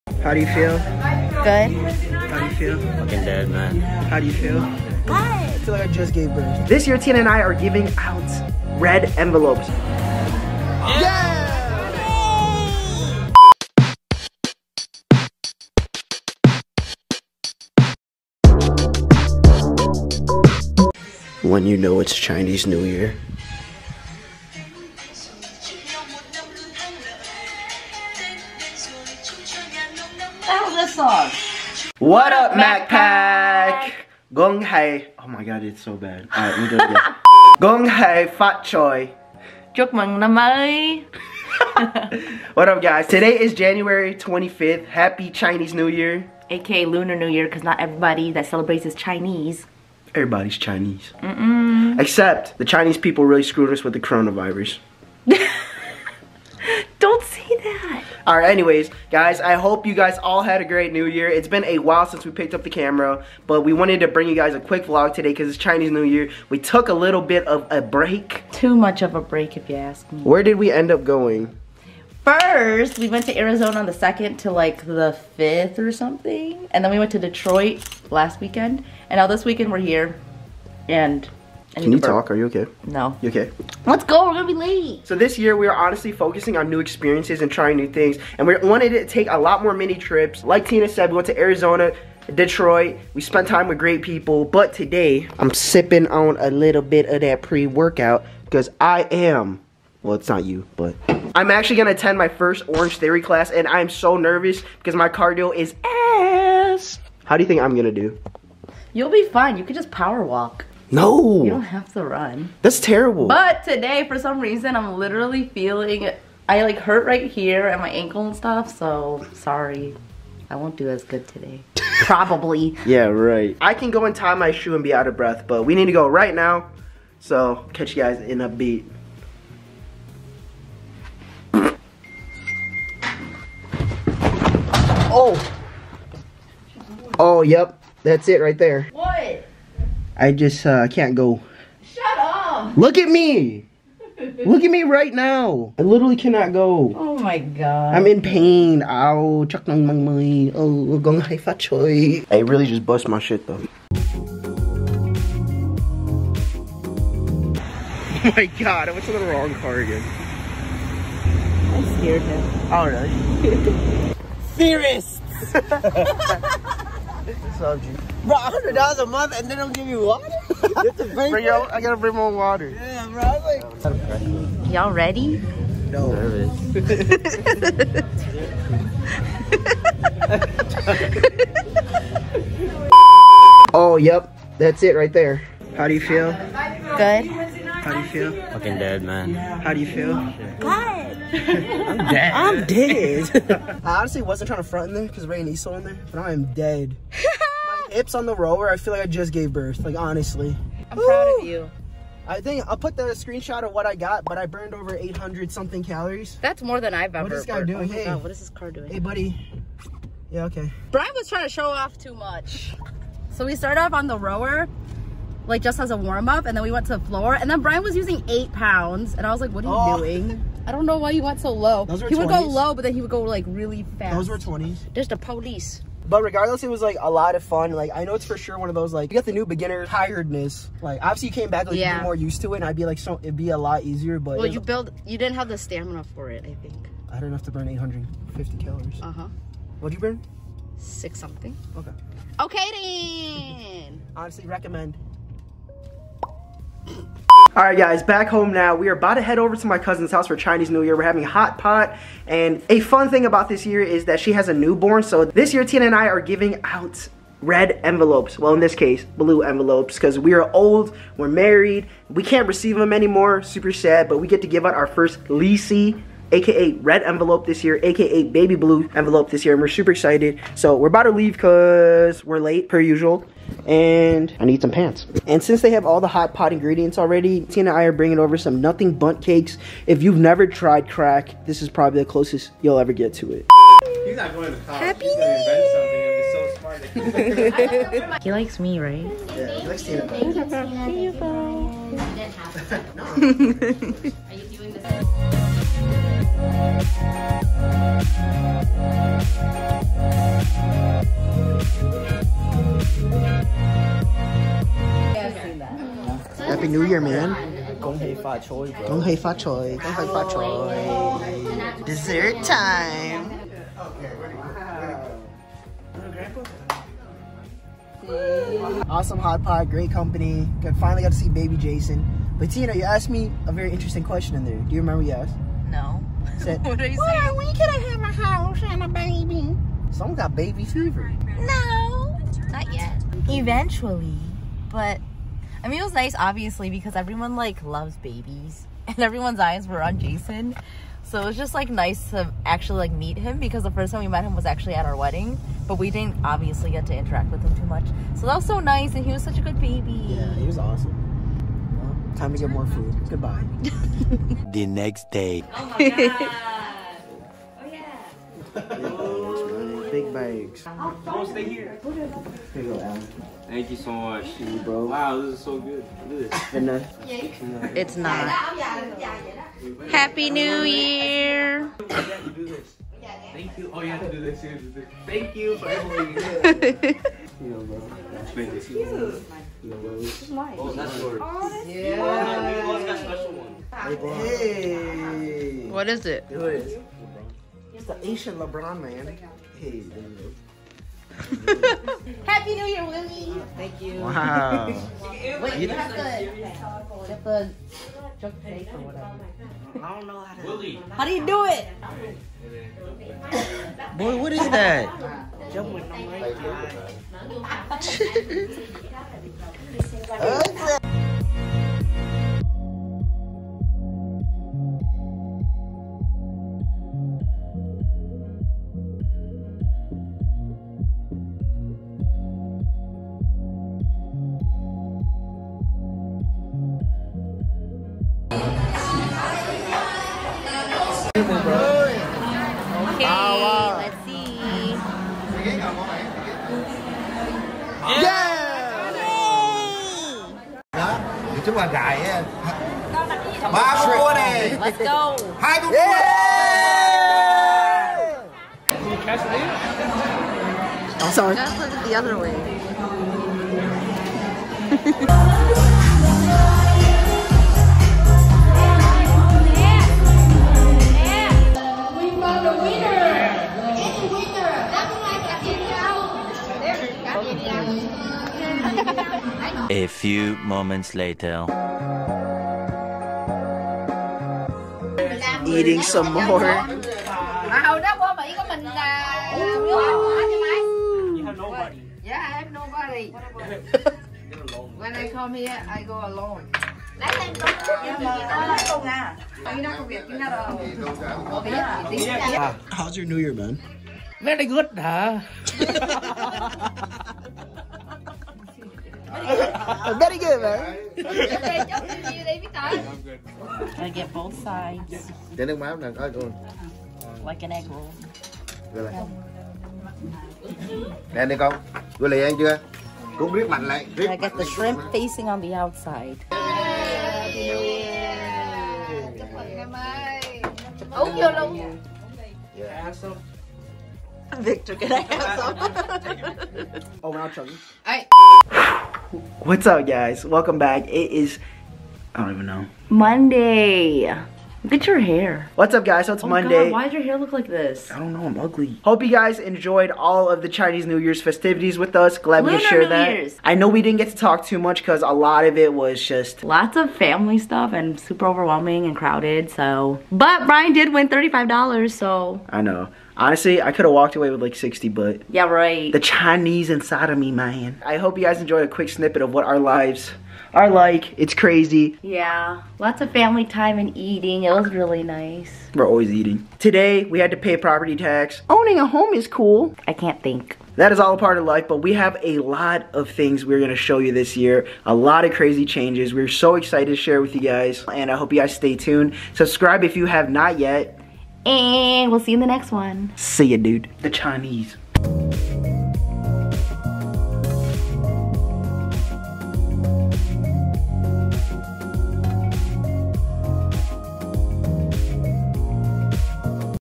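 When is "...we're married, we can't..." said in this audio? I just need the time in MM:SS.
04:21.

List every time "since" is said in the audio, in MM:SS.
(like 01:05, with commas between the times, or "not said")
01:02, 04:35.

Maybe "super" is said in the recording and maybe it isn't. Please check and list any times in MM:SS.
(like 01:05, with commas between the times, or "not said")
04:23, 04:29, 09:07.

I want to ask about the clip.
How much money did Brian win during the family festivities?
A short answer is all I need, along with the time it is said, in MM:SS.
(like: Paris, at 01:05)
$35, at 09:11.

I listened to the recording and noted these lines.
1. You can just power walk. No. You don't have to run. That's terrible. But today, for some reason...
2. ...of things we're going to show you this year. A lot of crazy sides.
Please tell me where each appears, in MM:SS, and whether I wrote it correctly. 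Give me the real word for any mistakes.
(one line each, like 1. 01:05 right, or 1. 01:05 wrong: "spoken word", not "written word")
1. 01:49 right
2. 09:32 wrong: "changes", not "sides".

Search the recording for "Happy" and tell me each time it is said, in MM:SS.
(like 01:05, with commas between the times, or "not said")
00:44, 04:44, 06:32.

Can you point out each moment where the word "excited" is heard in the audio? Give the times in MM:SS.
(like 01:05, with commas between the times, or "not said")
04:29, 09:36.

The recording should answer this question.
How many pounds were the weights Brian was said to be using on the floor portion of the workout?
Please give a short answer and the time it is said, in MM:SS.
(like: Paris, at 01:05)
8, at 03:38.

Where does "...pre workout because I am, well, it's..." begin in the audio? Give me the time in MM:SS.
01:37.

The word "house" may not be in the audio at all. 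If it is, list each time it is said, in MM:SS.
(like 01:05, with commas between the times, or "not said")
04:10, 05:28.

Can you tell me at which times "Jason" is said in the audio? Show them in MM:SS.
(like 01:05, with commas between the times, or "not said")
05:21, 05:39.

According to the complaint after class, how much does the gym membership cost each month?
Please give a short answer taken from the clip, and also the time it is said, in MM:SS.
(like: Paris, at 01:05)
$100, at 02:48.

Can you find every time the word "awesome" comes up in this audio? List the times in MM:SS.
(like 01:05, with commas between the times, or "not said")
05:18, 05:50.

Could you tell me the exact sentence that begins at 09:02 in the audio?
Glad Lunar we shared New that.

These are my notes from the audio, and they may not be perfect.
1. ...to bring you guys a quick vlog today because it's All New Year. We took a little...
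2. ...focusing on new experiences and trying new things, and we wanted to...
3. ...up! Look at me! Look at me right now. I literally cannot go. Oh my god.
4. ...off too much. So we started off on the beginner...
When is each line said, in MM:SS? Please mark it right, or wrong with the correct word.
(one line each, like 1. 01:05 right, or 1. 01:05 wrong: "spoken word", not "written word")
1. 01:04 wrong: "Chinese", not "All"
2. 01:26 right
3. 02:22 right
4. 03:31 wrong: "rower", not "beginner".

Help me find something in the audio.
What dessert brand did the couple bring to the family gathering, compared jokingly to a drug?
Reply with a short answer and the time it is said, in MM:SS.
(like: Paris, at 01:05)
Nothing Bundt Cakes, at 04:38.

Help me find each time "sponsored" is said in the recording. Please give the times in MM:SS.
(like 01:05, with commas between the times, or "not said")
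not said.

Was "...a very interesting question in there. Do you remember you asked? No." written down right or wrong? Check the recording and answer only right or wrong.
right.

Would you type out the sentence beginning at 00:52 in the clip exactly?
Except the Chinese people really screwed us with the coronavirus.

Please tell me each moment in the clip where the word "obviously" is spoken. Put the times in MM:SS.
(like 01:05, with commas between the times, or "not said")
03:51, 05:36, 05:46.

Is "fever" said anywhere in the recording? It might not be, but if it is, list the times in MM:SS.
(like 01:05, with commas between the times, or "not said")
05:30.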